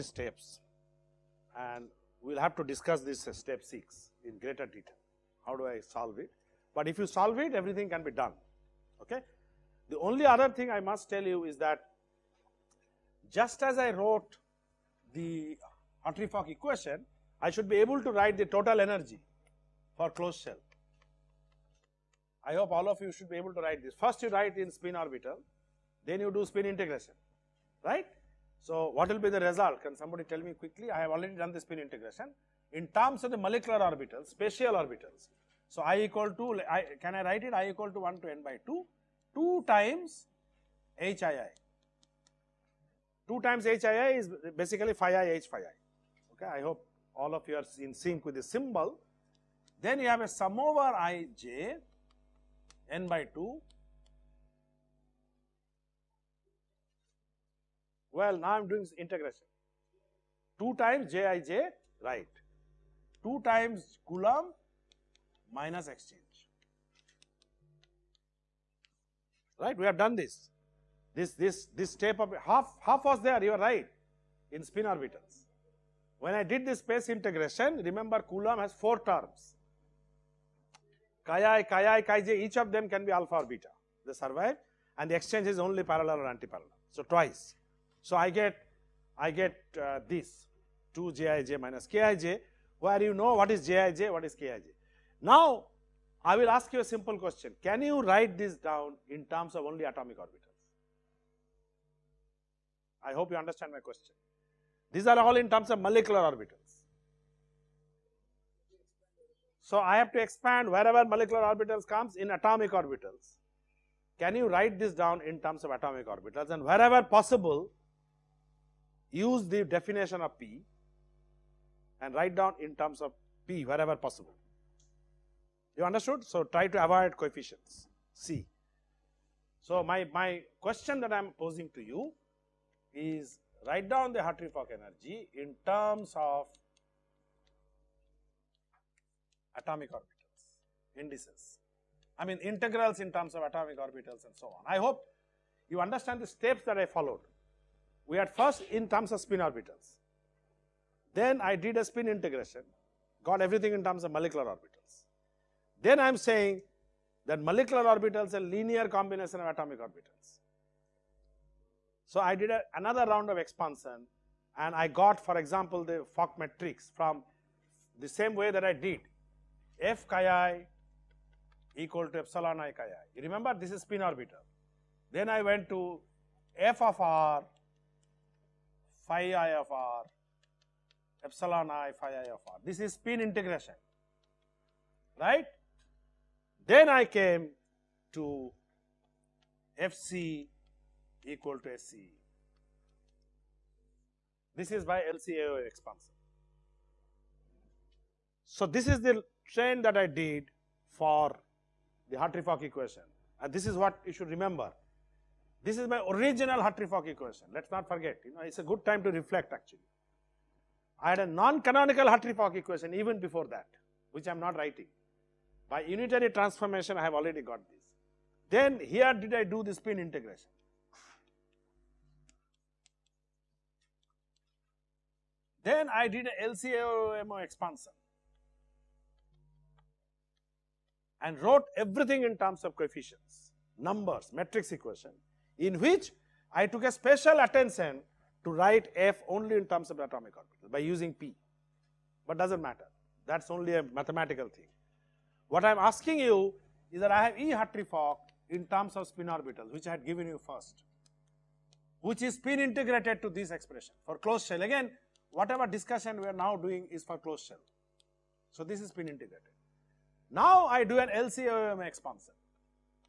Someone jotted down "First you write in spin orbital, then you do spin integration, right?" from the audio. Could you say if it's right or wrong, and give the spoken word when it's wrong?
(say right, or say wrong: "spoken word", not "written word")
right.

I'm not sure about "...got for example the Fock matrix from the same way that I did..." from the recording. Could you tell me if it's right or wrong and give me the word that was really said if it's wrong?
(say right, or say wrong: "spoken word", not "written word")
right.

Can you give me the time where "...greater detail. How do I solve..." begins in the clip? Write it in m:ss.
0:04.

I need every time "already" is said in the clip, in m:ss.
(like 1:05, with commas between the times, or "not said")
0:31, 3:37.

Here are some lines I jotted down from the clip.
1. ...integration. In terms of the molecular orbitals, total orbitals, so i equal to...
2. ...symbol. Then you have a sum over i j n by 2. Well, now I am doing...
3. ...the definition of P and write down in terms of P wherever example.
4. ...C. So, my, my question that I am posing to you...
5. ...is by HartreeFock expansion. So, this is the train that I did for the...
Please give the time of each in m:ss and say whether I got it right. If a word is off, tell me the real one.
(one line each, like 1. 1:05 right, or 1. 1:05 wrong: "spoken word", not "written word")
1. 0:31 wrong: "spatial", not "total"
2. 0:48 right
3. 1:59 wrong: "possible", not "example"
4. 2:08 right
5. 3:14 wrong: "LCAO", not "HartreeFock".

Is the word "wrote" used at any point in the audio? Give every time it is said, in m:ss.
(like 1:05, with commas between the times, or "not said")
0:13, 3:51.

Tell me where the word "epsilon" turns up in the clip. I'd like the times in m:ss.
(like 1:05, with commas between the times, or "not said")
2:52, 3:01.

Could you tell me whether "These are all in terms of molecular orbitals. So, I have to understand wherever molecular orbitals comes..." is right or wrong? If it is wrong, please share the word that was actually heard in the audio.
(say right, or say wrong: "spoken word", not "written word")
wrong: "expand", not "understand".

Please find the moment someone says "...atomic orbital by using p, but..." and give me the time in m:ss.
3:59.